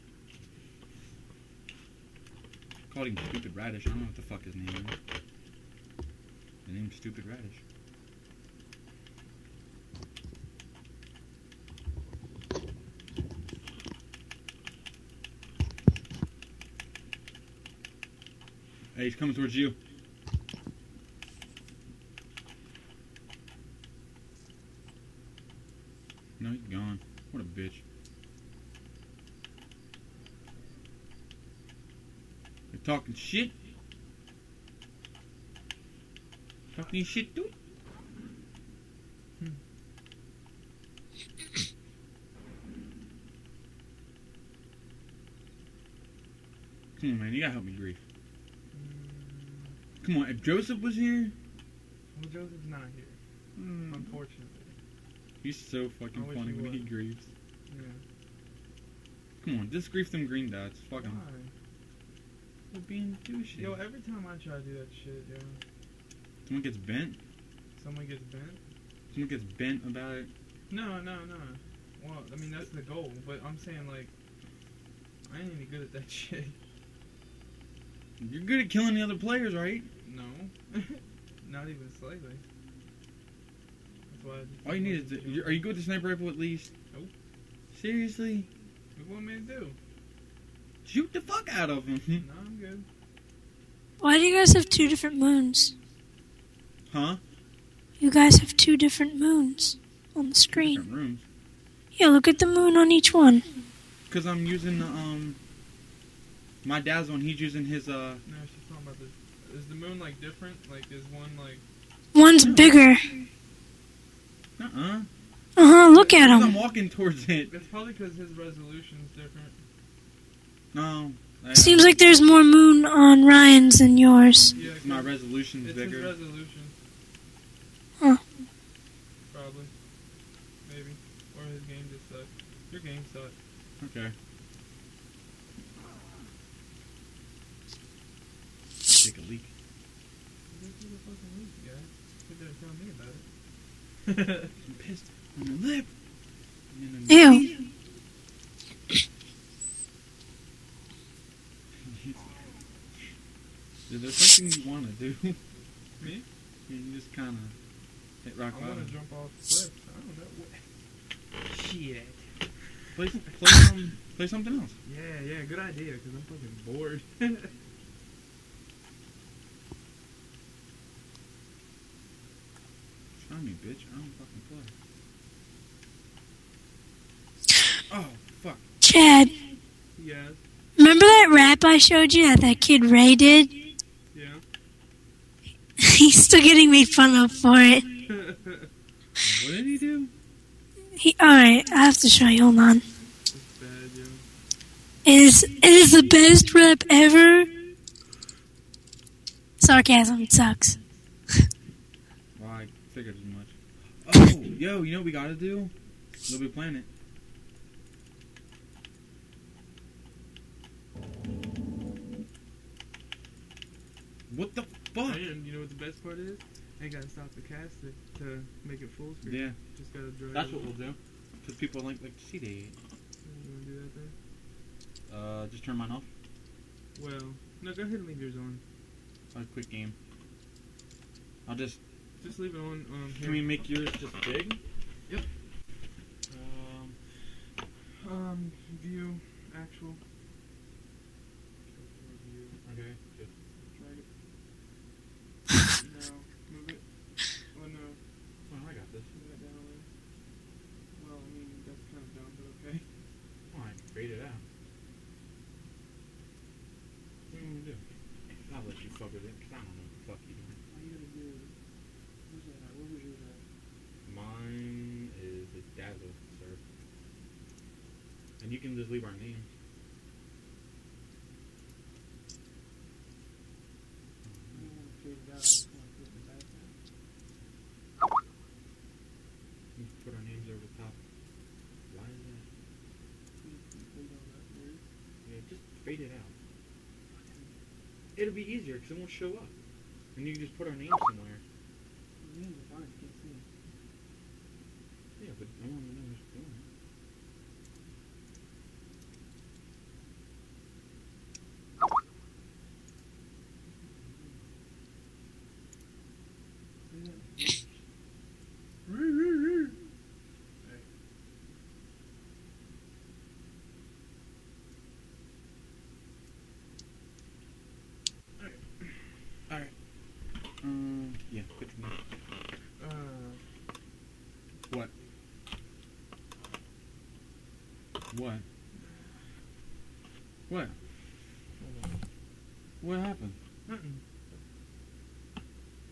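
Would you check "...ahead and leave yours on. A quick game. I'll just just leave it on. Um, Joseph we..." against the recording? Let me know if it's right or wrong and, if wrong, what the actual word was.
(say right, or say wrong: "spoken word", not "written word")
wrong: "Can", not "Joseph".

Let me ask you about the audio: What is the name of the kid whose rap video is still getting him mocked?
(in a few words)
Ray.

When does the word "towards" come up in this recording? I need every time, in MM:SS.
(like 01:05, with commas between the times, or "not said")
00:19, 01:56.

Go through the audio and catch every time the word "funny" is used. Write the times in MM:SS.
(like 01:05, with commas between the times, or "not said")
00:56.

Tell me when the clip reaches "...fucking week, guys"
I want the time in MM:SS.
02:21.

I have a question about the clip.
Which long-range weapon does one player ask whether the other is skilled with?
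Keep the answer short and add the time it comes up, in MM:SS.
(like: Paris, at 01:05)
Sniper rifle, at 01:25.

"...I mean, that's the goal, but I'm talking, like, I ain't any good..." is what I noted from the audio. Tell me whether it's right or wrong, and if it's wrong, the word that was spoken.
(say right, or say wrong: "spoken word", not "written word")
wrong: "saying", not "talking".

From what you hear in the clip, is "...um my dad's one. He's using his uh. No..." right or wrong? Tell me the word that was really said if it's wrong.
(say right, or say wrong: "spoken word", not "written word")
right.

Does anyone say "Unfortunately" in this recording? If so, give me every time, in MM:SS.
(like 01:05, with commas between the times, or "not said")
00:53.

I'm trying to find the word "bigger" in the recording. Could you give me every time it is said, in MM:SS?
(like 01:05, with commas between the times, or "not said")
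01:52, 02:05.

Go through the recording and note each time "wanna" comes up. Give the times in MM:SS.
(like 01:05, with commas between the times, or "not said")
03:43.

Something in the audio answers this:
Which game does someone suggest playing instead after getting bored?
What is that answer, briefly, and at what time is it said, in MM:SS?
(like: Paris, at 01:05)
Little Big Planet, at 03:26.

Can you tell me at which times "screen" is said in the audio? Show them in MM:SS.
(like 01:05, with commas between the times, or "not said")
01:40, 03:39.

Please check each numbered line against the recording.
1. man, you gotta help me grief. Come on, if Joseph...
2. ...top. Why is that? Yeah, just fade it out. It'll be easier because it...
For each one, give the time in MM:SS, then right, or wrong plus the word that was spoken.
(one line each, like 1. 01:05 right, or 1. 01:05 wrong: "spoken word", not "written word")
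1. 00:47 right
2. 04:40 right.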